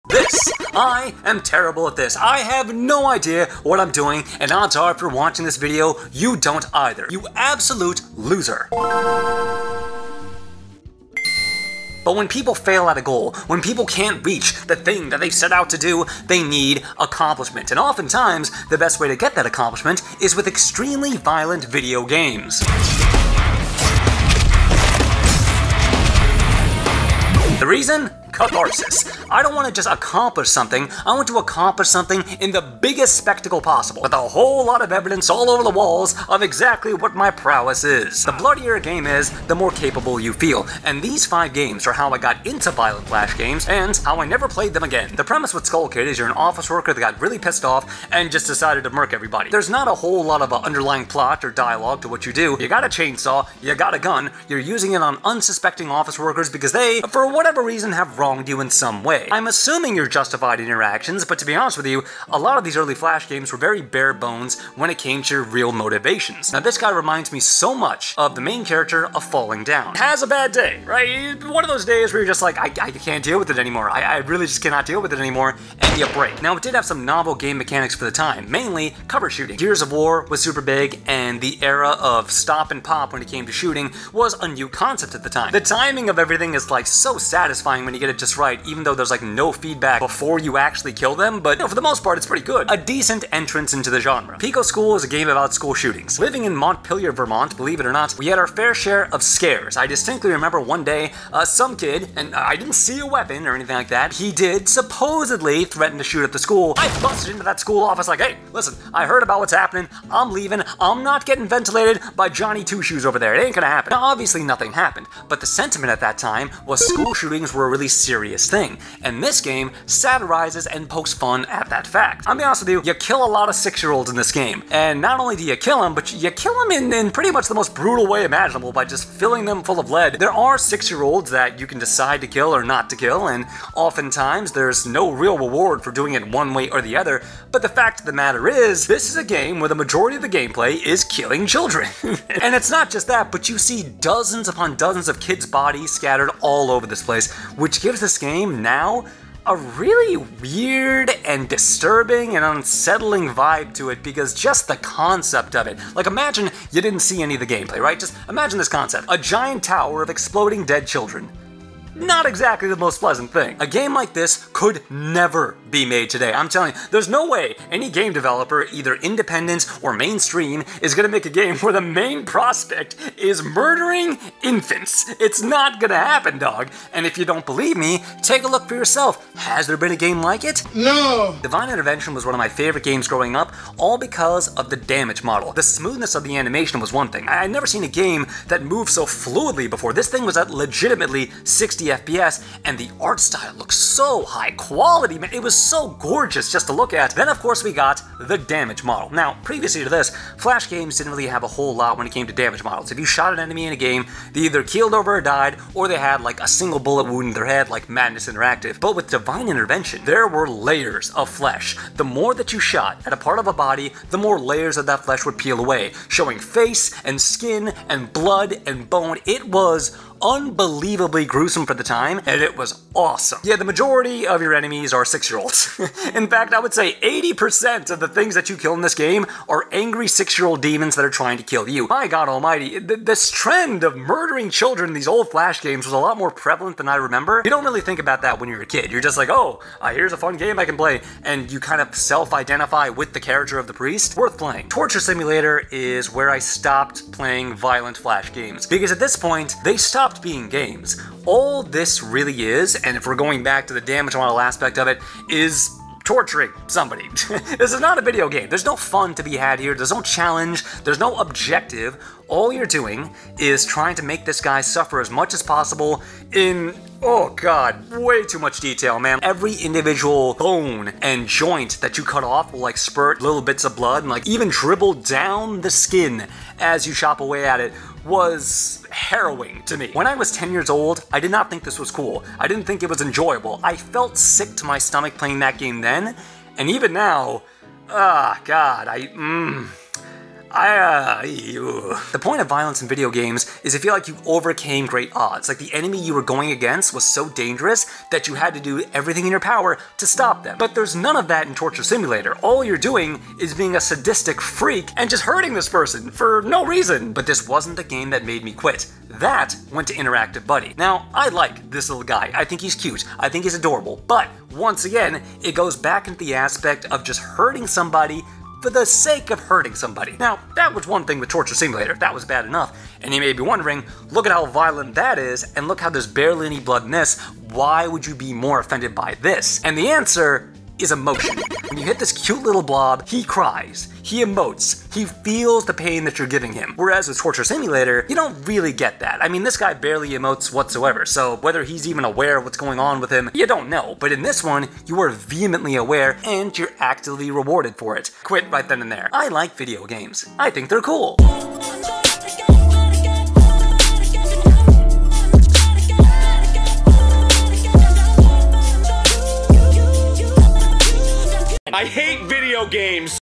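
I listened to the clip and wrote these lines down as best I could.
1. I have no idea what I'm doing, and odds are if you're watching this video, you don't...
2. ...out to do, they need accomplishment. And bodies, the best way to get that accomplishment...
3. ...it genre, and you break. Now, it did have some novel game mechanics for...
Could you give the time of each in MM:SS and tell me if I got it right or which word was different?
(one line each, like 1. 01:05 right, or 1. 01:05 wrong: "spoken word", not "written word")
1. 00:02 right
2. 00:15 wrong: "oftentimes", not "bodies"
3. 01:15 wrong: "anymore", not "genre".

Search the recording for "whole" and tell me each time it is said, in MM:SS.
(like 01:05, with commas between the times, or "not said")
00:34, 00:49, 03:21.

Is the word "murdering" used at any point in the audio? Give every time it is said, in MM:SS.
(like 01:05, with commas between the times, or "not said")
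02:53, 03:53.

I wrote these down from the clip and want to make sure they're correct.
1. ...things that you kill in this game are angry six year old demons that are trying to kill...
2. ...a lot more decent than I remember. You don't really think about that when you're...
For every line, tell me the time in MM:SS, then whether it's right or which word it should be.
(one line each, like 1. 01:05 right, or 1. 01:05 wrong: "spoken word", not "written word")
1. 03:48 right
2. 03:55 wrong: "prevalent", not "decent".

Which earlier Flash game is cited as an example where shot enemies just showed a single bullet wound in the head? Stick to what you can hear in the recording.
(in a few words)
Madness Interactive.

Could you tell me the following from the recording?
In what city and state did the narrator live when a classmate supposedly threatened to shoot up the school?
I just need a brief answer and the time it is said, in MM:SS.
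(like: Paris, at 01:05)
Montpelier, Vermont, at 01:36.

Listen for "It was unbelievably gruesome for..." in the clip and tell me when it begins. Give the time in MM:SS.
03:39.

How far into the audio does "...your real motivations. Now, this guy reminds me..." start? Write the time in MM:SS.
01:05.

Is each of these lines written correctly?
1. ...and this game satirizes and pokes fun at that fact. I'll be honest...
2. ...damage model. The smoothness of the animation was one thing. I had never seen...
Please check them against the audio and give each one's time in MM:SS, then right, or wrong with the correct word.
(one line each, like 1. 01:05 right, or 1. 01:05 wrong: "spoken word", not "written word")
1. 01:59 right
2. 03:04 right.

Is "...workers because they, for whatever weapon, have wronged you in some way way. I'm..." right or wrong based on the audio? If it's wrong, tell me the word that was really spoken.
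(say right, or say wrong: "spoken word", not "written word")
wrong: "reason", not "weapon".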